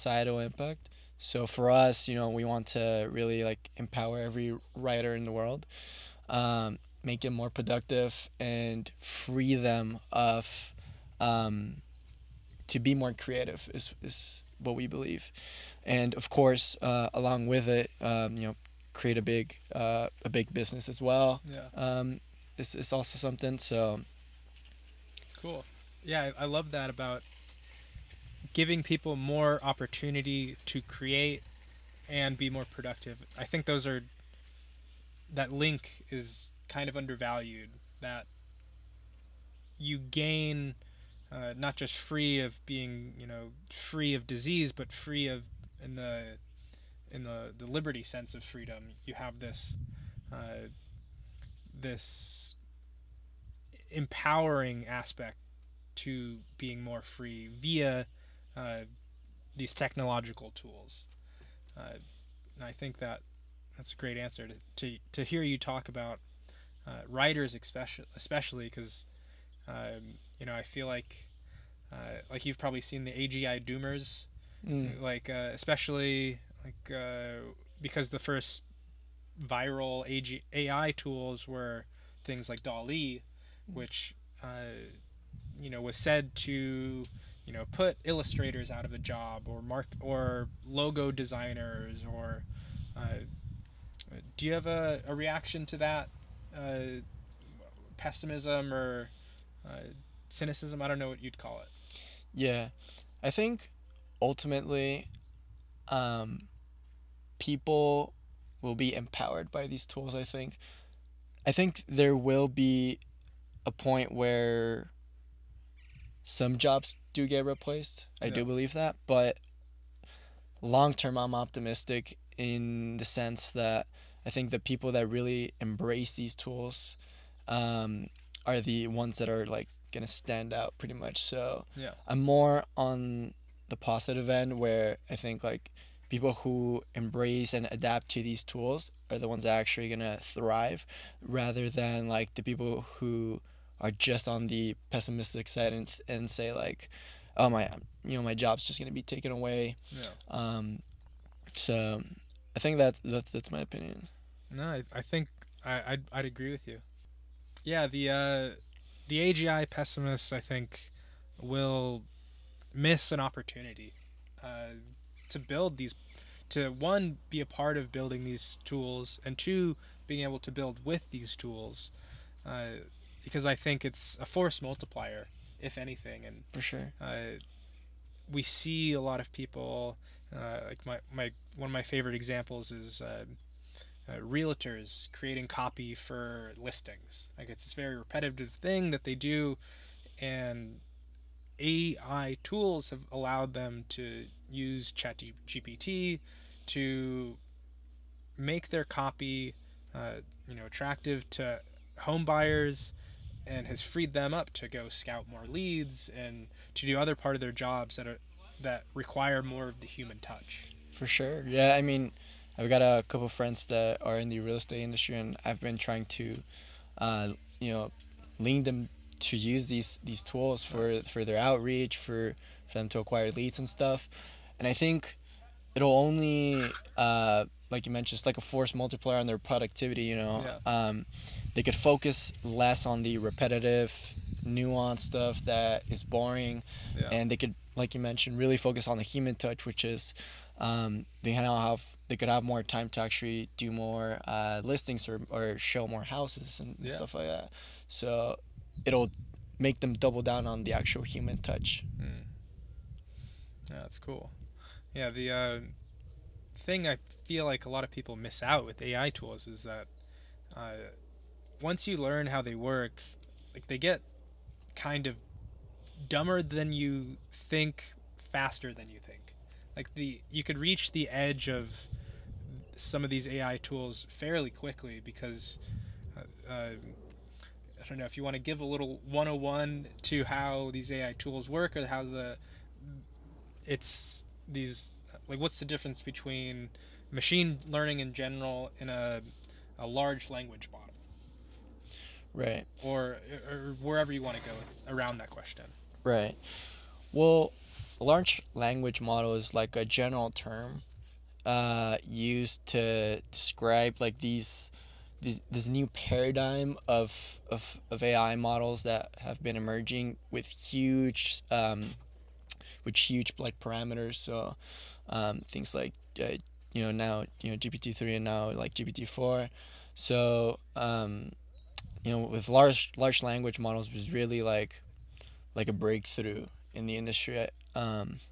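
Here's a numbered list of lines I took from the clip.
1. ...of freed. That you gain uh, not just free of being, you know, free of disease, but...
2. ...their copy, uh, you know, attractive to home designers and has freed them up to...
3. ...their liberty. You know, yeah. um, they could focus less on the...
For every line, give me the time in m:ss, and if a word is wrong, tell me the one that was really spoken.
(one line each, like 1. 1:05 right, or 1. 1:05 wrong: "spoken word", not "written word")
1. 0:36 wrong: "undervalued", not "freed"
2. 3:18 wrong: "buyers", not "designers"
3. 3:49 wrong: "productivity", not "liberty".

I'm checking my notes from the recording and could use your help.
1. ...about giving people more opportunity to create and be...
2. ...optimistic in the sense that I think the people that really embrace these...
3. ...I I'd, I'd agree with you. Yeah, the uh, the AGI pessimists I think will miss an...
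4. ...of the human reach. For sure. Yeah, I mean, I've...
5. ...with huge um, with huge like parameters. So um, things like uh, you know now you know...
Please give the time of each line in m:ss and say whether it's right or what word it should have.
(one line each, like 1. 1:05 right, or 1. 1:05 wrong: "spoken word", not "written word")
1. 0:26 right
2. 2:01 right
3. 2:35 right
4. 3:29 wrong: "touch", not "reach"
5. 5:10 right.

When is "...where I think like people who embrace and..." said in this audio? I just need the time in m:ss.
2:14.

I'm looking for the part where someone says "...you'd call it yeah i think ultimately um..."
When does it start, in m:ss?
1:41.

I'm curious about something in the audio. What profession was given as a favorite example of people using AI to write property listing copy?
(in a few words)
realtors.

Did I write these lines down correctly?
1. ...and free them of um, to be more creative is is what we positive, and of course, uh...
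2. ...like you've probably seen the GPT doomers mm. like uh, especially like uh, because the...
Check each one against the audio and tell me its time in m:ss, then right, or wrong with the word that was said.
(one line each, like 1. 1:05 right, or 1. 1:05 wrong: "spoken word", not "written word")
1. 0:08 wrong: "believe", not "positive"
2. 1:12 wrong: "AGI", not "GPT".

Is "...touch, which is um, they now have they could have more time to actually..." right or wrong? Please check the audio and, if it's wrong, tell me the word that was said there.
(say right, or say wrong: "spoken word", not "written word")
right.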